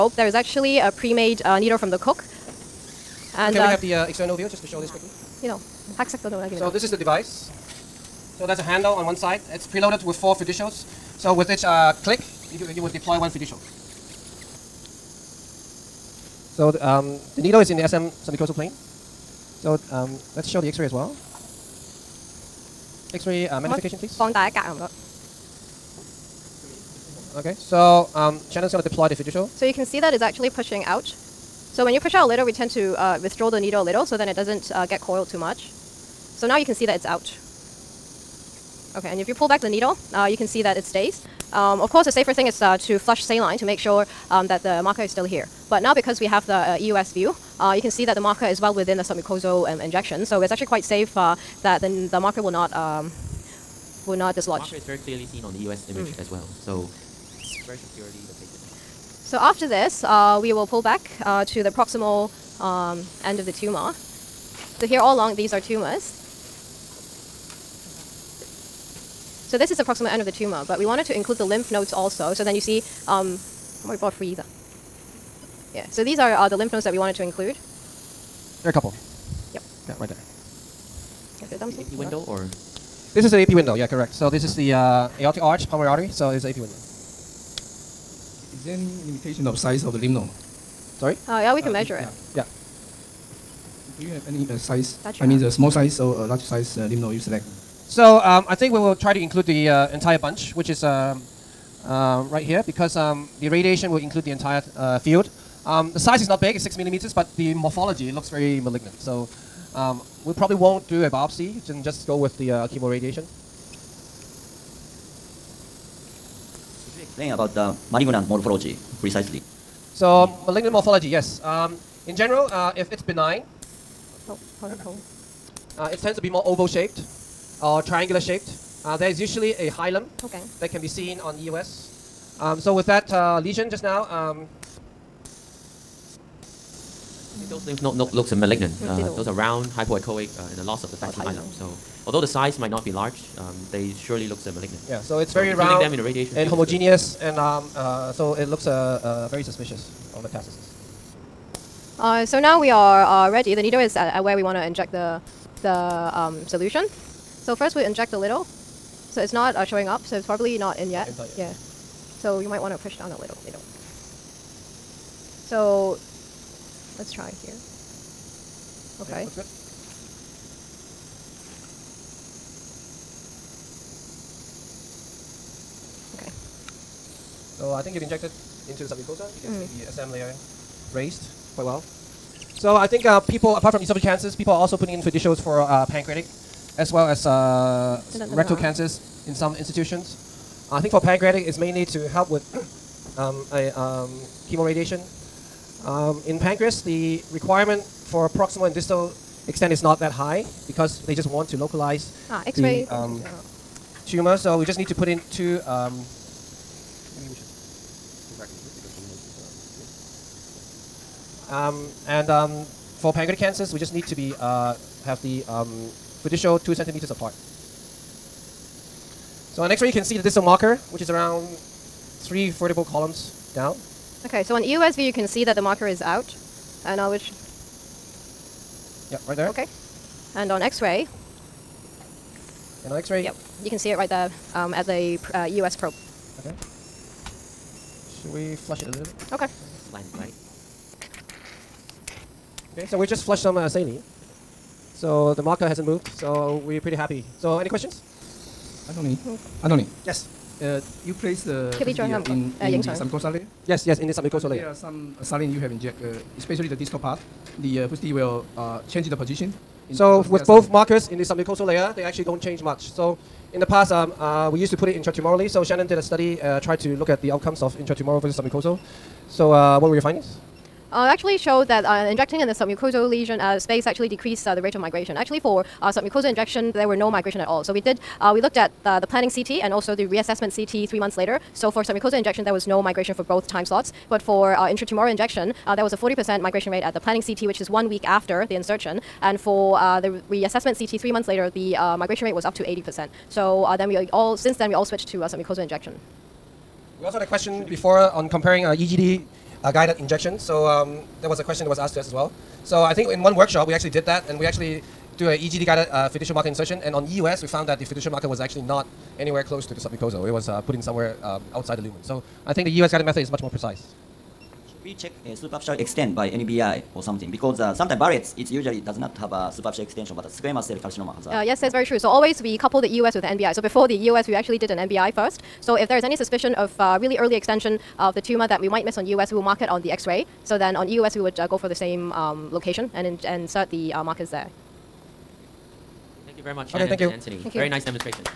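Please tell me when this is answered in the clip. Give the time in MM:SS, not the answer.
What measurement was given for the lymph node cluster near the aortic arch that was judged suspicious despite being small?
01:46.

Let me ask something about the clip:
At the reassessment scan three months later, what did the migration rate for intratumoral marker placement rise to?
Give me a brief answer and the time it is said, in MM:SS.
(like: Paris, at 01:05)
80%, at 04:52.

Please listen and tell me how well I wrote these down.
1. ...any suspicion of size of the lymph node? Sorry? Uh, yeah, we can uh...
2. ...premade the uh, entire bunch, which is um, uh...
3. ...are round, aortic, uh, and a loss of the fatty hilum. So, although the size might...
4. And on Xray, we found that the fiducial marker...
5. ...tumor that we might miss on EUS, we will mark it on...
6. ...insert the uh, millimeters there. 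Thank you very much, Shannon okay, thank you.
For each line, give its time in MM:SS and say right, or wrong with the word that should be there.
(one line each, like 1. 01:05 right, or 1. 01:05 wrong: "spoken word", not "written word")
1. 01:28 wrong: "limitation", not "suspicion"
2. 01:39 wrong: "include", not "premade"
3. 02:19 wrong: "hypoechoic", not "aortic"
4. 05:06 wrong: "EUS", not "Xray"
5. 05:28 right
6. 05:33 wrong: "markers", not "millimeters".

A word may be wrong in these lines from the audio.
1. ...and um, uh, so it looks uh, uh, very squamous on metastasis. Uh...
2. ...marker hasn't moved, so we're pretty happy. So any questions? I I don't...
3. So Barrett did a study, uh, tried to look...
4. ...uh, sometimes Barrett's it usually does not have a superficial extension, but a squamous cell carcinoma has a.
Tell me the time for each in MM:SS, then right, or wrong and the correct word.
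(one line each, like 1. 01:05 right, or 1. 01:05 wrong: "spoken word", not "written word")
1. 02:27 wrong: "suspicious", not "squamous"
2. 04:05 right
3. 04:25 wrong: "Shannon", not "Barrett"
4. 05:17 right.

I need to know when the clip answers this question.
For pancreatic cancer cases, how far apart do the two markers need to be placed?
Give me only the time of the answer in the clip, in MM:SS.
03:36.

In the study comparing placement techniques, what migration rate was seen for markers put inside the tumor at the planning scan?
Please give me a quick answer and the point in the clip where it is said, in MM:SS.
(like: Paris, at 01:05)
40%, at 04:45.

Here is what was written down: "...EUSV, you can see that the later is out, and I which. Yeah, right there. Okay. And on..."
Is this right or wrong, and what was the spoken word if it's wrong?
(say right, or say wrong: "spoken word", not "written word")
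wrong: "marker", not "later".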